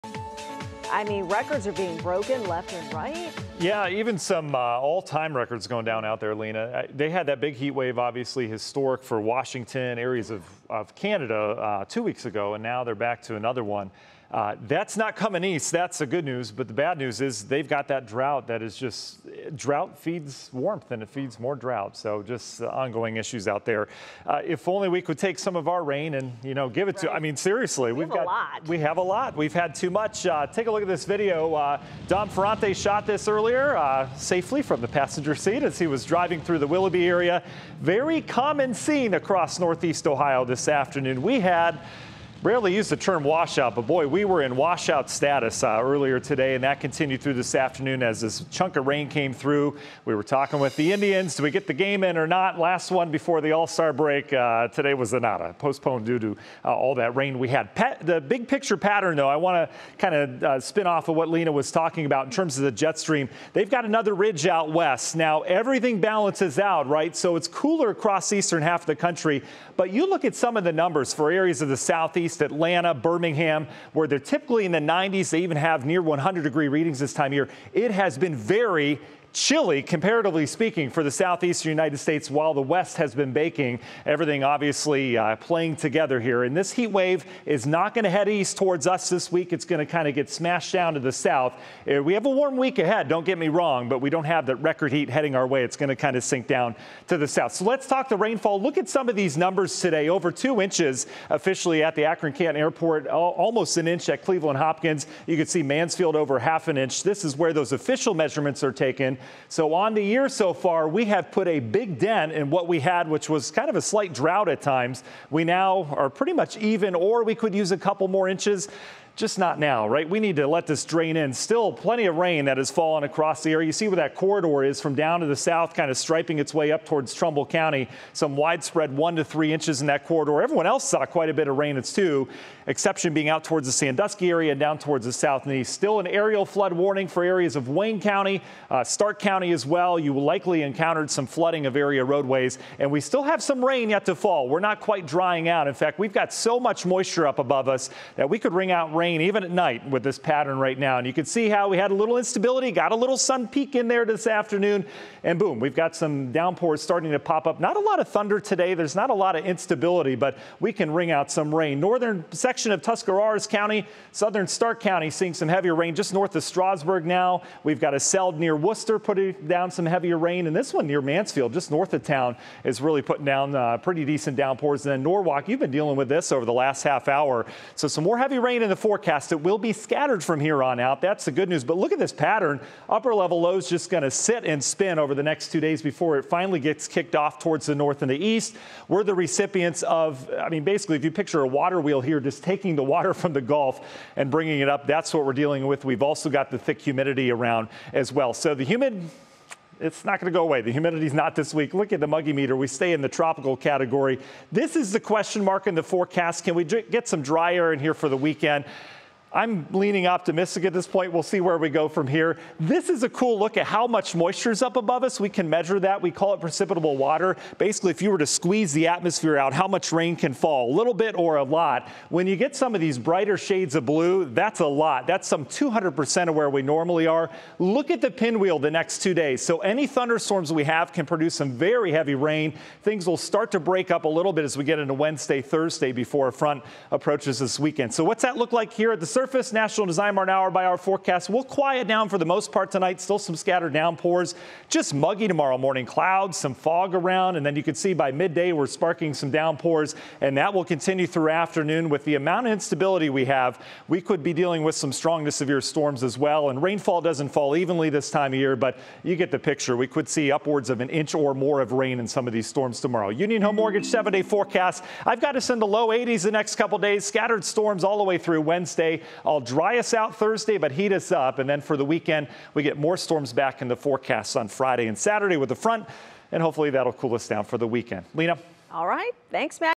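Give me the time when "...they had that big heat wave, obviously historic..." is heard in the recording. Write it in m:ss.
0:06.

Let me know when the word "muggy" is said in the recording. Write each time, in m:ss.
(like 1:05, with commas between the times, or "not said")
3:22, 4:04.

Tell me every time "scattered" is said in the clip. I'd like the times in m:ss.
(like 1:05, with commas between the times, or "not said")
2:59, 4:03, 4:27.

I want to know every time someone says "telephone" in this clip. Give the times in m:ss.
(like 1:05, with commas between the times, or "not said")
not said.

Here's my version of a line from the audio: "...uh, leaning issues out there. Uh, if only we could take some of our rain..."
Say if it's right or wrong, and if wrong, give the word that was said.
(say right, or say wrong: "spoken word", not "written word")
wrong: "ongoing", not "leaning".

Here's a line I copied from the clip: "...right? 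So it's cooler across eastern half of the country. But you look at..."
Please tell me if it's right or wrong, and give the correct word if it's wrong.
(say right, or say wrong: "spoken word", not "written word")
right.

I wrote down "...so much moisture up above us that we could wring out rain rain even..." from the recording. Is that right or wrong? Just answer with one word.
right.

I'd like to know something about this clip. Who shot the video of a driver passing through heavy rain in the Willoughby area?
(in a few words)
Dom Ferrante.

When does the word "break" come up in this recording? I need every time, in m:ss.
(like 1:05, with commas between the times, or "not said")
0:53, 3:53.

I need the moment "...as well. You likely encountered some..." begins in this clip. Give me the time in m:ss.
2:19.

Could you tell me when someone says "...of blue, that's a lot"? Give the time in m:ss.
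3:43.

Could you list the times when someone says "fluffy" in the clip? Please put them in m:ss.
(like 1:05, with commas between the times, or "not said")
not said.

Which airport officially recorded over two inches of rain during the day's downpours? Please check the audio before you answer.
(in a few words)
Akron Canton Airport.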